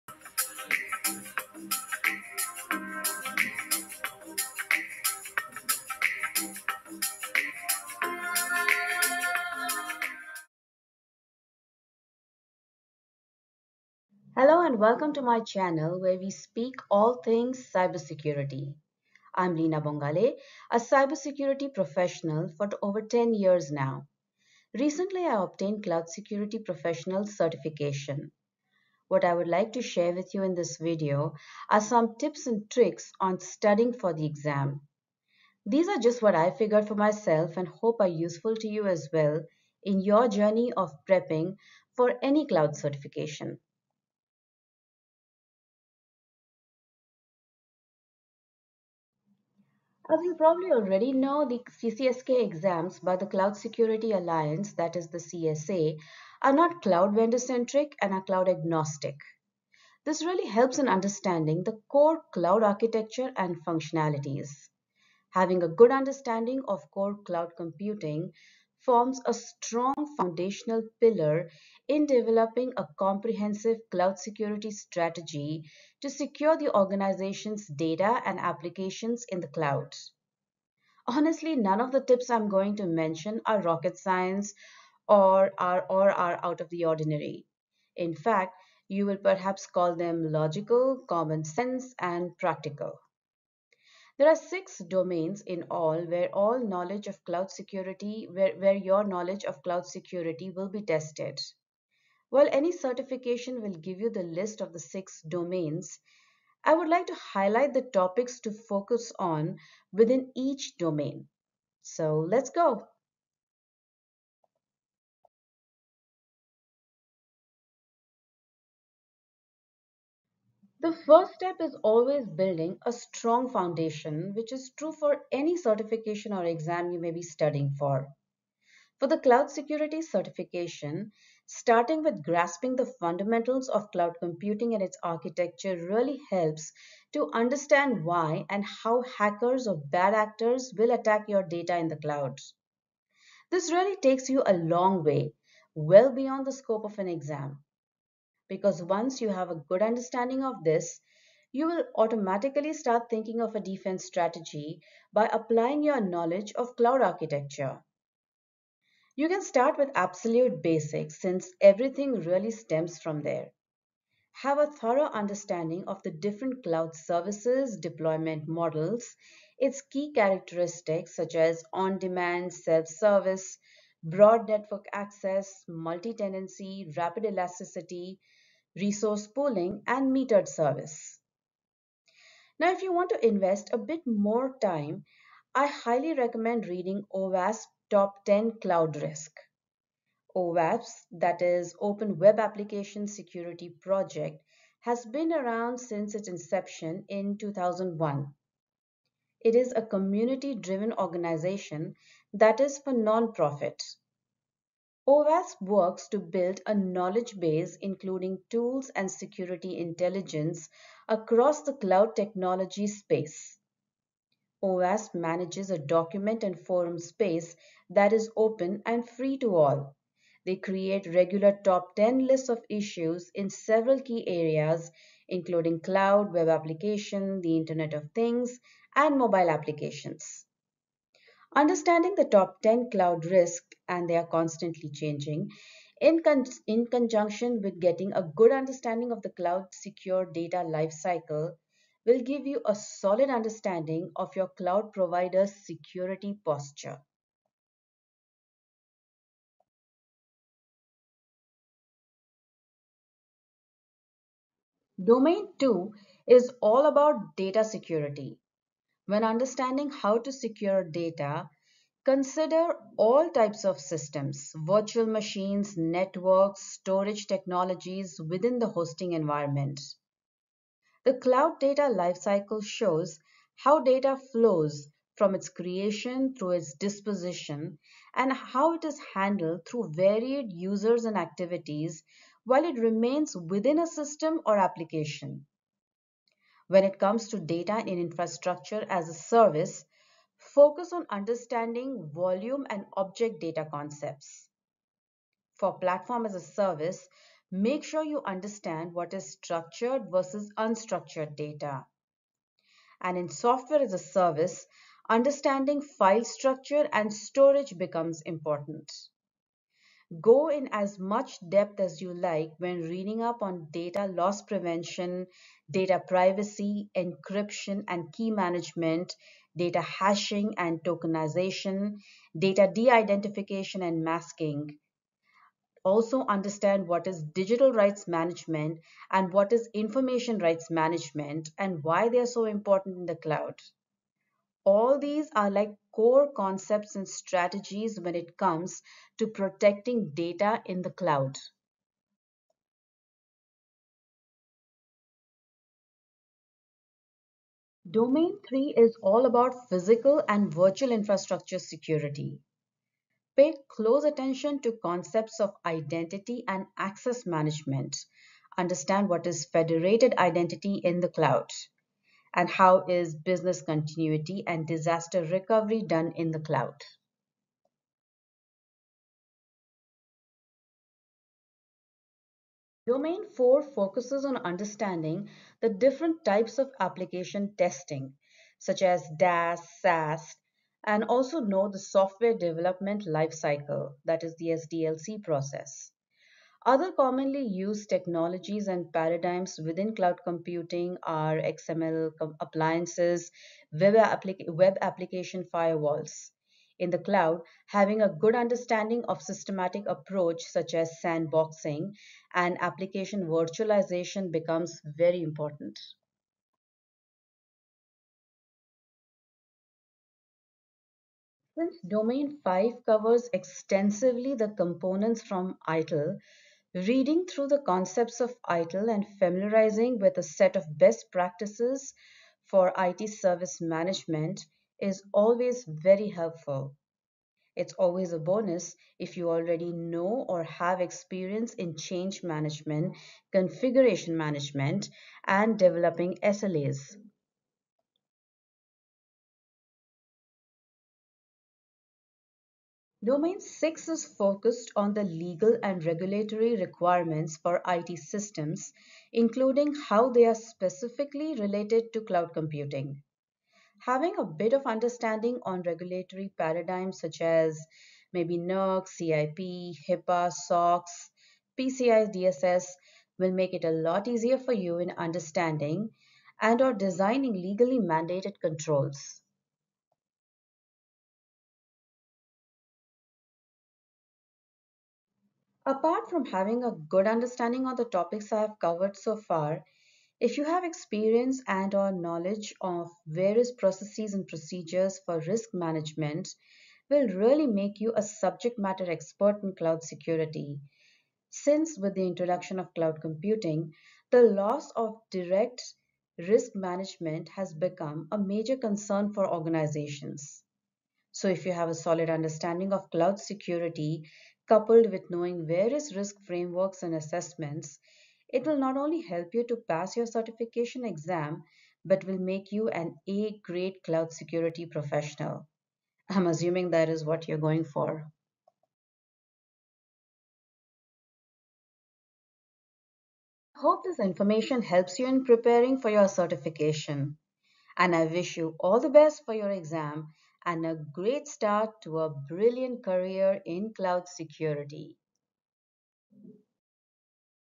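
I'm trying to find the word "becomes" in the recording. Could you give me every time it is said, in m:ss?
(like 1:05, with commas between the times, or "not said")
5:07, 6:44, 8:17.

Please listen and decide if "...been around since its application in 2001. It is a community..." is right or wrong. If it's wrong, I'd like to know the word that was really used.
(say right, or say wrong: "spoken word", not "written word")
wrong: "inception", not "application".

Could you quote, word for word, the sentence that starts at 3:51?
Understanding the top 10 cloud risk and they are constantly changing.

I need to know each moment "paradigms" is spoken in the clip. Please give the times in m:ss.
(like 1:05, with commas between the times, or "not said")
6:28, 7:36.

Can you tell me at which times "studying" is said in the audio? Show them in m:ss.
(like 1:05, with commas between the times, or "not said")
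0:33, 2:07.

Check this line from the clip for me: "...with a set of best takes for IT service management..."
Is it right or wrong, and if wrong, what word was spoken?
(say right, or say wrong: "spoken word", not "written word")
wrong: "practices", not "takes".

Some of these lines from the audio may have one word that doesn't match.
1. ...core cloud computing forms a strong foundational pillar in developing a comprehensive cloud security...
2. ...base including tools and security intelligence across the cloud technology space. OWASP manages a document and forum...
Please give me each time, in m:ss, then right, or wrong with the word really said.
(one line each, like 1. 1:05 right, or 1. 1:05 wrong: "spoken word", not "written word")
1. 1:06 right
2. 3:27 right.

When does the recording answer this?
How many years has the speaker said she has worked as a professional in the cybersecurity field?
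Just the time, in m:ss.
0:23.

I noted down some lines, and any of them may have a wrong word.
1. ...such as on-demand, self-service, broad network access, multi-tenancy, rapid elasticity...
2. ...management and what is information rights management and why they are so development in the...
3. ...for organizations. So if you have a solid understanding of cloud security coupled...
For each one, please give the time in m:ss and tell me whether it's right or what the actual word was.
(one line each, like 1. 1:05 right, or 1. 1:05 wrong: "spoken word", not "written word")
1. 2:51 right
2. 5:28 wrong: "important", not "development"
3. 8:19 right.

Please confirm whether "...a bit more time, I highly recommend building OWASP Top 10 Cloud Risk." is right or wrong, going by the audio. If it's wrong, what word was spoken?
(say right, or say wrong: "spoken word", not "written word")
wrong: "reading", not "building".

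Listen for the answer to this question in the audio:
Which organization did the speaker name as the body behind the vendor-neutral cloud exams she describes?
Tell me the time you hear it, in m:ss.
0:53.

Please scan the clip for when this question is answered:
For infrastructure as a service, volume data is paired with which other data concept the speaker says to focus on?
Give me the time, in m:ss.
4:52.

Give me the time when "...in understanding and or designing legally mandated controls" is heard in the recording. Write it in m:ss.
7:44.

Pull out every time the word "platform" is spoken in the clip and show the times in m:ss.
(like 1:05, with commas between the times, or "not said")
4:55.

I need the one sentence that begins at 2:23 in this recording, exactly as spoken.
This really takes you a long way, well beyond the scope of an exam.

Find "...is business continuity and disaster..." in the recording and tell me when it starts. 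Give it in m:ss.
6:02.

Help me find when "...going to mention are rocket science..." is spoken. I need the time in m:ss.
1:22.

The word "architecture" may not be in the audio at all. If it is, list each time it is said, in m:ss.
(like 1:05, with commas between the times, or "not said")
1:02, 2:15, 2:37.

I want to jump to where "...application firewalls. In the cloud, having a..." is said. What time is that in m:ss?
6:34.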